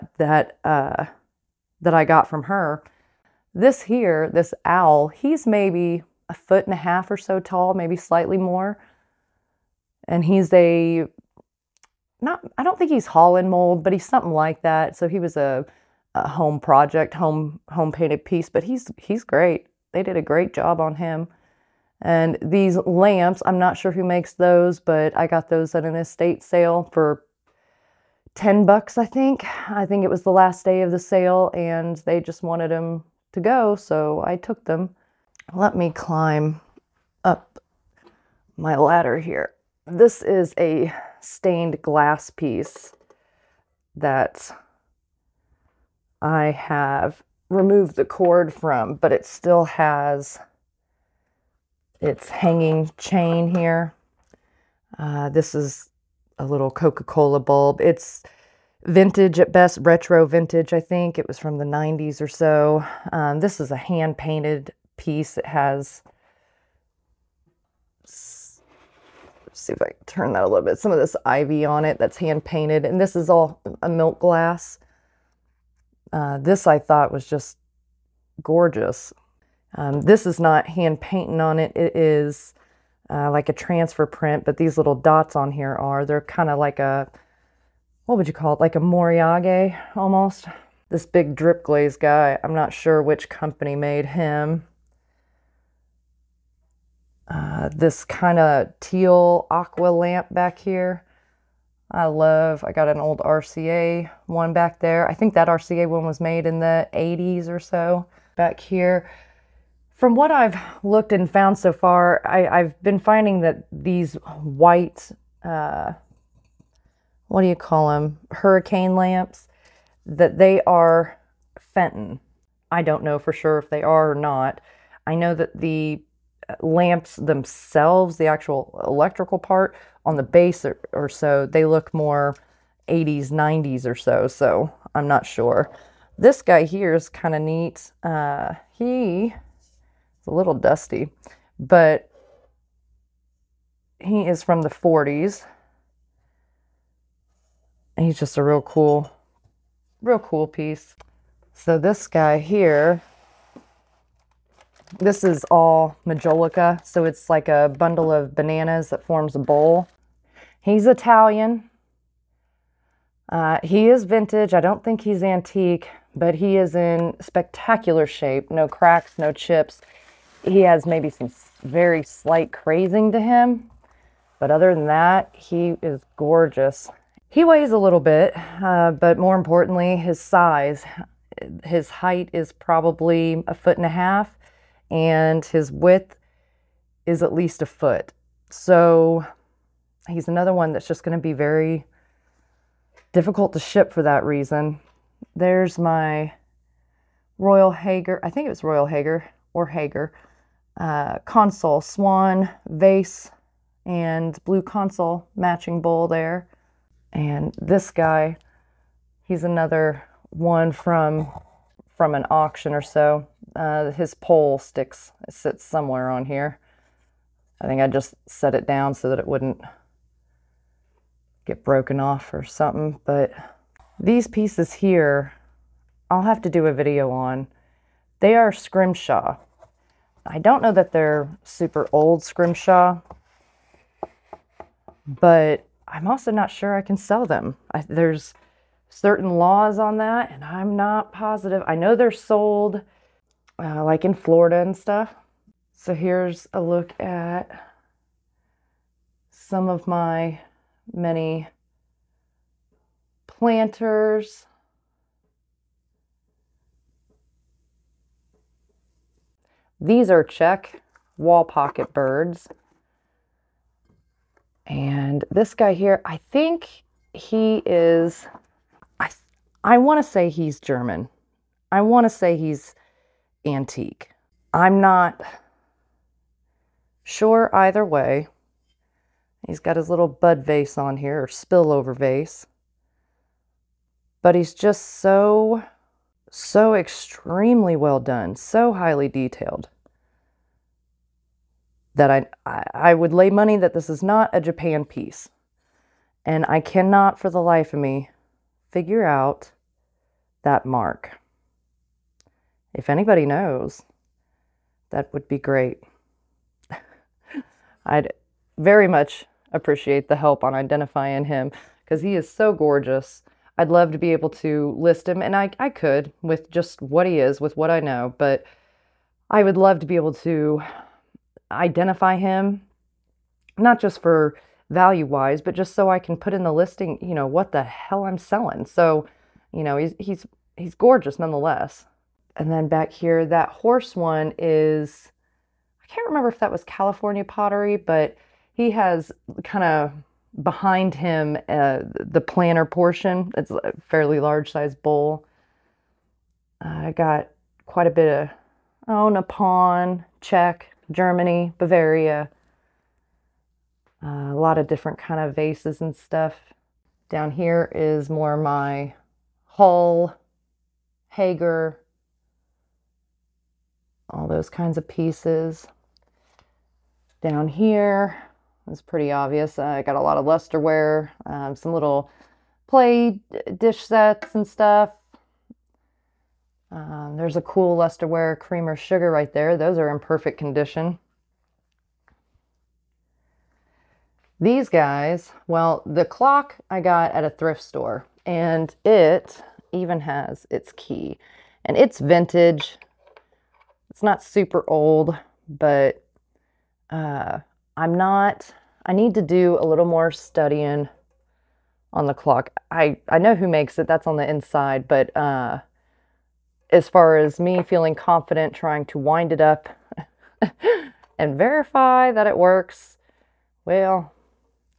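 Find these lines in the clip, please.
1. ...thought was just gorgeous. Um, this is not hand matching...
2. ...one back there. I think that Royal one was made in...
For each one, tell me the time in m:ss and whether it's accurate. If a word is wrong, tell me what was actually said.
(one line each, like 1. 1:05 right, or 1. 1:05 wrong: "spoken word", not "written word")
1. 1:16 wrong: "painting", not "matching"
2. 1:44 wrong: "RCA", not "Royal".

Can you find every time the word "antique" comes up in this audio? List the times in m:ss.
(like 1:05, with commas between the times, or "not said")
2:45, 4:33.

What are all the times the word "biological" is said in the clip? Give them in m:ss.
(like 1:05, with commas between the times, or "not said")
not said.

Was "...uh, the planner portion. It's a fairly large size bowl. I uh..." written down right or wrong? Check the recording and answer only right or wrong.
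right.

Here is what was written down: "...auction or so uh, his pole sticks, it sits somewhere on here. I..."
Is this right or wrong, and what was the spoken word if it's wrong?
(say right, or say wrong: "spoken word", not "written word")
right.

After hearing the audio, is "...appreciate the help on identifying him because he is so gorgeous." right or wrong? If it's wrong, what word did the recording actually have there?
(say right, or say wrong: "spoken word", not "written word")
right.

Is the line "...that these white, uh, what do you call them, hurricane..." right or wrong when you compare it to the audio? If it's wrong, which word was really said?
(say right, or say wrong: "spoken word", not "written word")
right.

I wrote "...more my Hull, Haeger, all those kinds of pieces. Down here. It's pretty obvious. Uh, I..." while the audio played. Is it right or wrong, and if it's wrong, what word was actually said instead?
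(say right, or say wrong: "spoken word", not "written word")
right.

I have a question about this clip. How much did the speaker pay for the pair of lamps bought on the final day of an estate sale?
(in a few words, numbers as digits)
$10.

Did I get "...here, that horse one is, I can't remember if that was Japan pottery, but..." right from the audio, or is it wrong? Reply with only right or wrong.
wrong.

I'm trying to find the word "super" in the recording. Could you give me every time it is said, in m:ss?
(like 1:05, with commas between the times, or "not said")
3:51, 6:34.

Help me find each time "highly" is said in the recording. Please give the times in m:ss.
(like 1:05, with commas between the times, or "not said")
4:48.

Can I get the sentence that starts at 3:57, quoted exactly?
I, there's certain laws on that, and I'm not positive.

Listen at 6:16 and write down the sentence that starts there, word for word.
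Um, there's a cool lusterware creamer sugar right there.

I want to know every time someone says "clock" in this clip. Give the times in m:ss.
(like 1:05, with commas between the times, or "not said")
6:26, 6:42.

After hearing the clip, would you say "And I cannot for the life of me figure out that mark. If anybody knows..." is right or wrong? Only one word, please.
right.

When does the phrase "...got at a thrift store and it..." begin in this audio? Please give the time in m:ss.
6:26.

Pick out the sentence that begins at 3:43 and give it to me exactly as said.
But these pieces here, I'll have to do a video on.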